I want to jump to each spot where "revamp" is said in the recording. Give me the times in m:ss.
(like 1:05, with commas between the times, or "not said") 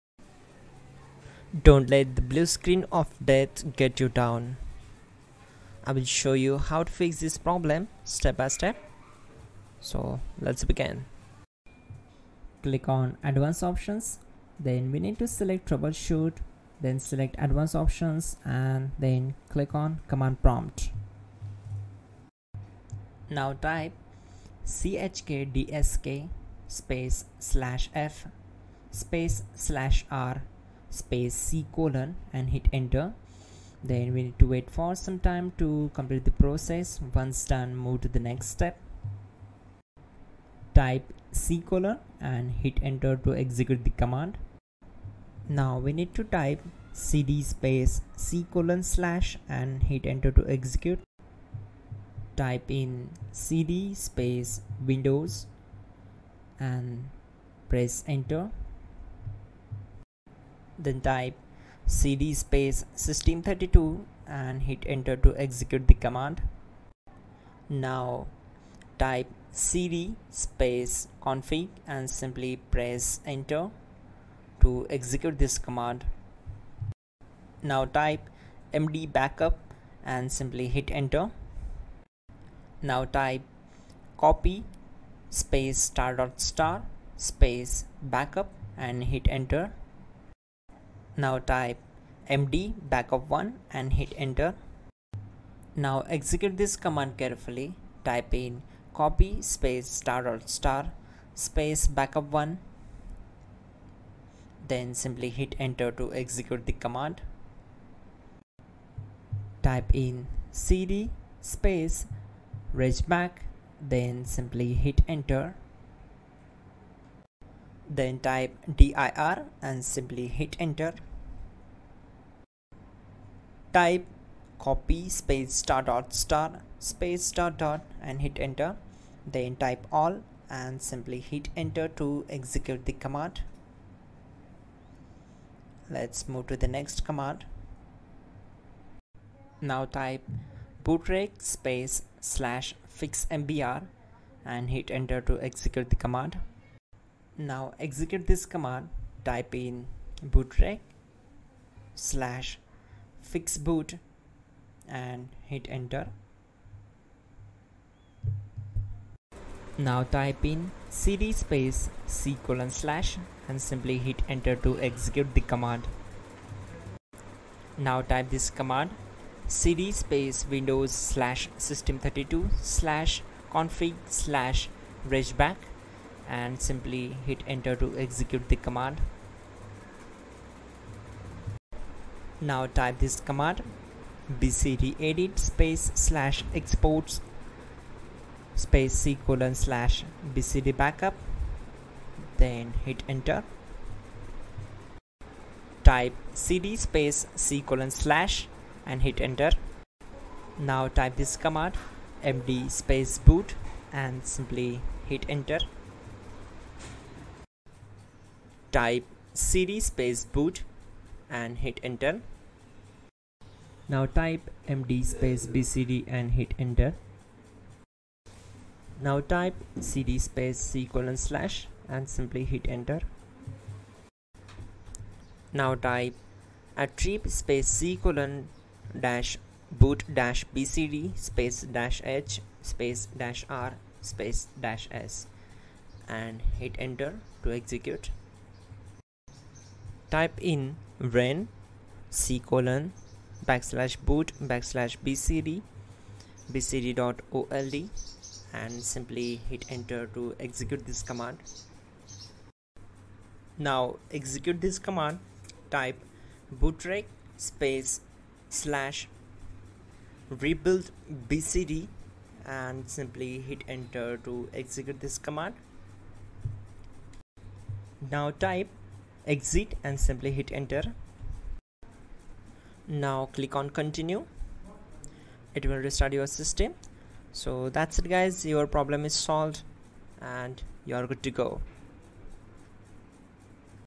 not said.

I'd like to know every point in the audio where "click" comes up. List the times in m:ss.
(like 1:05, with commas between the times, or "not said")
0:12, 0:19, 4:33.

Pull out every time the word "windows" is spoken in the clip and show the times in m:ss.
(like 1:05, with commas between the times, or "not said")
0:54, 2:50.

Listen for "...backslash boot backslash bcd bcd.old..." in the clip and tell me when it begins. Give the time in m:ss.
4:03.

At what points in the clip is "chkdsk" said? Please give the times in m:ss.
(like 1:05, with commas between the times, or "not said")
0:24.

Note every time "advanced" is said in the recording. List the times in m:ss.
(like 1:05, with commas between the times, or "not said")
0:13, 0:17.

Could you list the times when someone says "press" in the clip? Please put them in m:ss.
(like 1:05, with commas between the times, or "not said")
0:57, 1:12.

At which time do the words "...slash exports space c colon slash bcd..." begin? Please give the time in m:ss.
3:05.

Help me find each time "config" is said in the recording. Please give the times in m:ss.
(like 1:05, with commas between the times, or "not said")
1:11, 2:53.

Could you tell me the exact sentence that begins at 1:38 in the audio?
Type in copy space star star space backup 1 then simply hit enter to execute the command.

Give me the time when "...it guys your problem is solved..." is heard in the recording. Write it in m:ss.
4:37.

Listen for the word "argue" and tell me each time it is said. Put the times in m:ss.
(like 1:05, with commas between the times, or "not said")
not said.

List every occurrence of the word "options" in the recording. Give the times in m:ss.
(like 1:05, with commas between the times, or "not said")
0:13, 0:17.